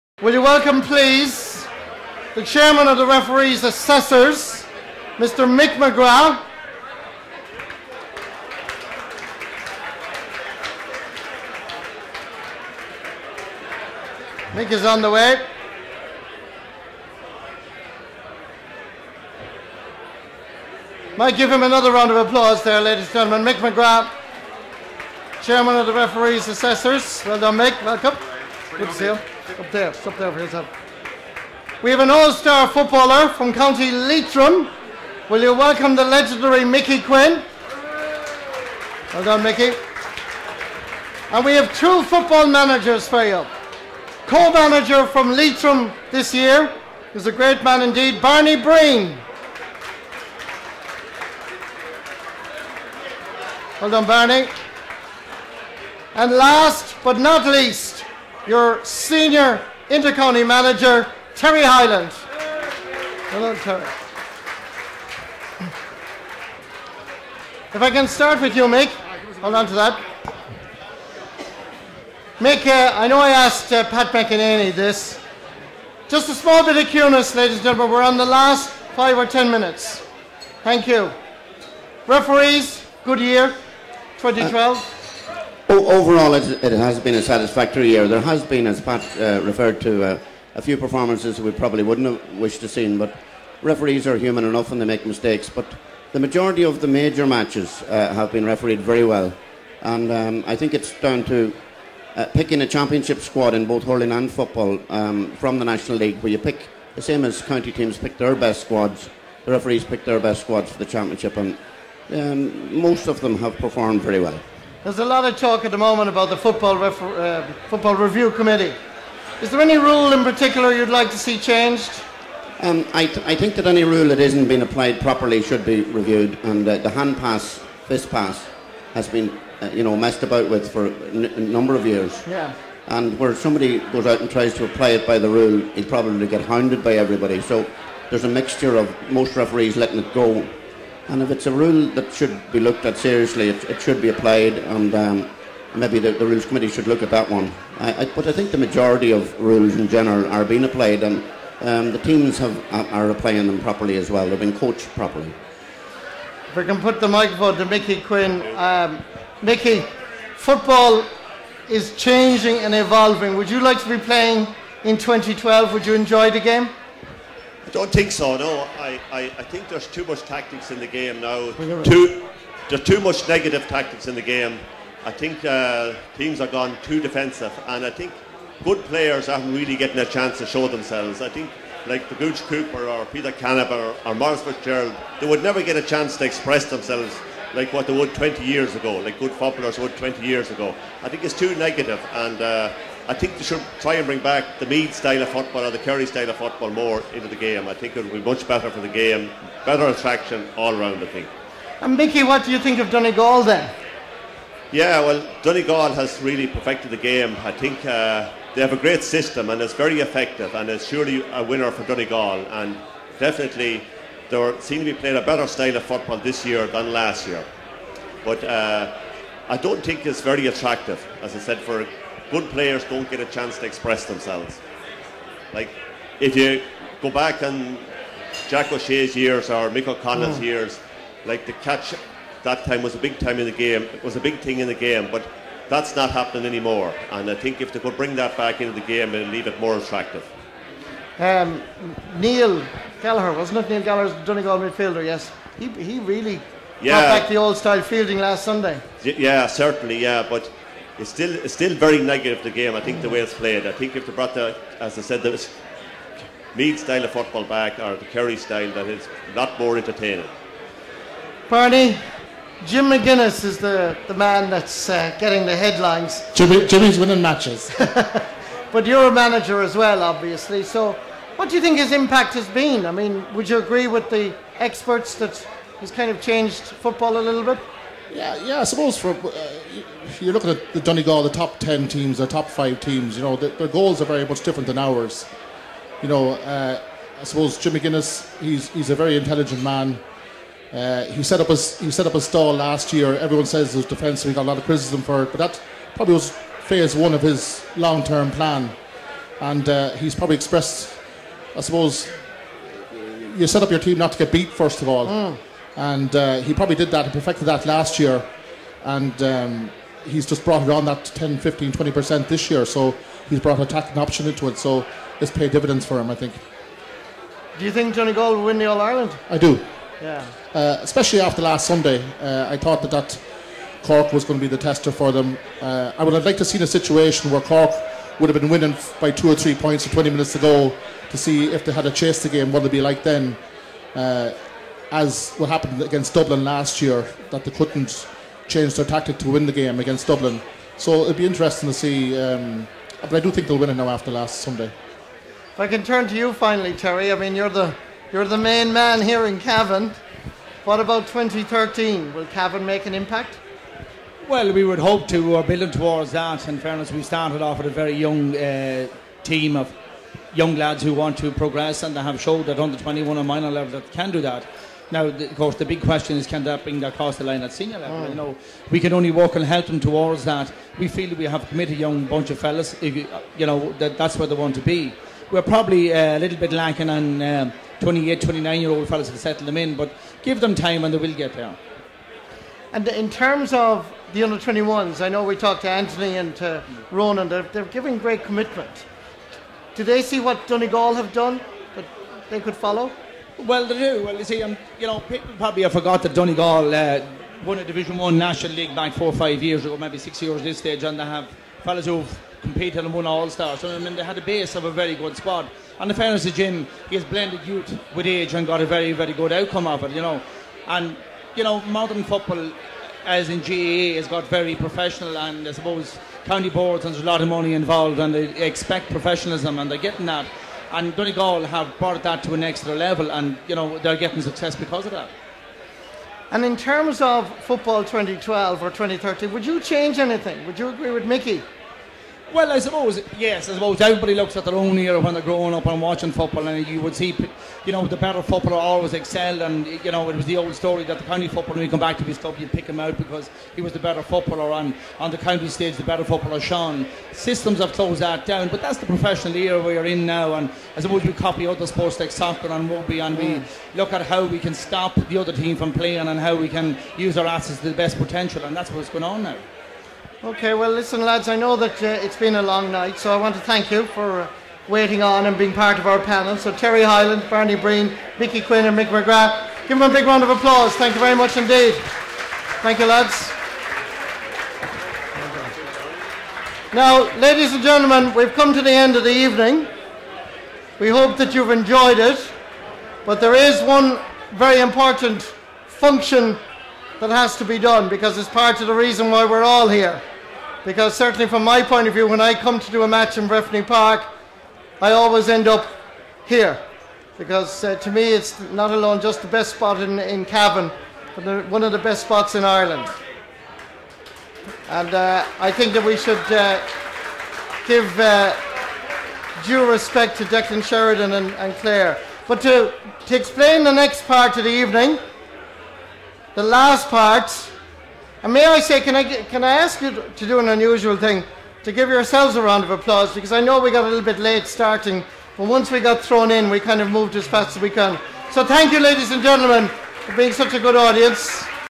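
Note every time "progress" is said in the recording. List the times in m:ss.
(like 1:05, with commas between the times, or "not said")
6:01.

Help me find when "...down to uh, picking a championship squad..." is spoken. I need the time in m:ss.
1:40.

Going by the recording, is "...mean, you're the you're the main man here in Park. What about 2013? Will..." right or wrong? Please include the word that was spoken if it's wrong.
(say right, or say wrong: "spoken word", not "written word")
wrong: "Cavan", not "Park".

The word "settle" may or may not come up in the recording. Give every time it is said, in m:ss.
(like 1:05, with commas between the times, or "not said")
6:19.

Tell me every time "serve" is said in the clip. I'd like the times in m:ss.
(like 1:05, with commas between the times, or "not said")
not said.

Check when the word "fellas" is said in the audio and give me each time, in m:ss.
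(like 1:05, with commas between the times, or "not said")
6:12, 6:18, 6:41.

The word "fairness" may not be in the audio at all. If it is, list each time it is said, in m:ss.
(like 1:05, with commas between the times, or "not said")
5:56, 6:45.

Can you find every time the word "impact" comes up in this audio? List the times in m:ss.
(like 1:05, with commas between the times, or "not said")
4:31, 5:52.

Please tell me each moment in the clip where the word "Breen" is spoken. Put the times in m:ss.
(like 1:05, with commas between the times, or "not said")
0:48, 7:47.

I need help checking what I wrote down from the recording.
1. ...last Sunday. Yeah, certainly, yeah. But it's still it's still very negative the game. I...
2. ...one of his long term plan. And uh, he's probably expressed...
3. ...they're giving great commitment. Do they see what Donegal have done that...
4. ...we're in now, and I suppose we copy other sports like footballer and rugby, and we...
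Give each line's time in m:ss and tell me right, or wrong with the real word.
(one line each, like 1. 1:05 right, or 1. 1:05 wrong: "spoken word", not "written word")
1. 4:08 right
2. 4:56 right
3. 6:27 right
4. 7:29 wrong: "soccer", not "footballer".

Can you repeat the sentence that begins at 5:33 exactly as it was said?
Uh, as what happened against Dublin last year, that they couldn't change their tactic to win the game against Dublin.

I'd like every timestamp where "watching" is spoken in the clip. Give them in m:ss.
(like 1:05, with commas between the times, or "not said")
7:15.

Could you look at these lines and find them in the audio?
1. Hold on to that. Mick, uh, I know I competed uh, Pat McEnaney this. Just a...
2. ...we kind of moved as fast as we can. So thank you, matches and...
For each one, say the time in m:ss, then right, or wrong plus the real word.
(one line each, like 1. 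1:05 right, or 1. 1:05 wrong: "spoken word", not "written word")
1. 1:09 wrong: "asked", not "competed"
2. 8:46 wrong: "ladies", not "matches".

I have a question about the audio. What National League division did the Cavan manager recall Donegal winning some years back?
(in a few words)
Division One.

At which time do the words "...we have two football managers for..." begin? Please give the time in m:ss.
0:41.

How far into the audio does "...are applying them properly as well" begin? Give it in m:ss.
2:32.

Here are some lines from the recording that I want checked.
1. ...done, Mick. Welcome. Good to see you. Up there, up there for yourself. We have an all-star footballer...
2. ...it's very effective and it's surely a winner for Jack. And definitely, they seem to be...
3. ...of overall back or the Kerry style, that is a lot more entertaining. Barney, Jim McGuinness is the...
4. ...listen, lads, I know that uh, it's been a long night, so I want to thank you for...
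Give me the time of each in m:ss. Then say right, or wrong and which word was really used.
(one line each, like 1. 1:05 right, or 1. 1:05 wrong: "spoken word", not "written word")
1. 0:27 right
2. 3:29 wrong: "Donegal", not "Jack"
3. 4:17 wrong: "football", not "overall"
4. 7:40 right.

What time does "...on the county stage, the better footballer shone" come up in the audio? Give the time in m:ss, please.
7:24.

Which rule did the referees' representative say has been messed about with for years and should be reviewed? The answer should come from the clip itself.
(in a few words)
Hand pass.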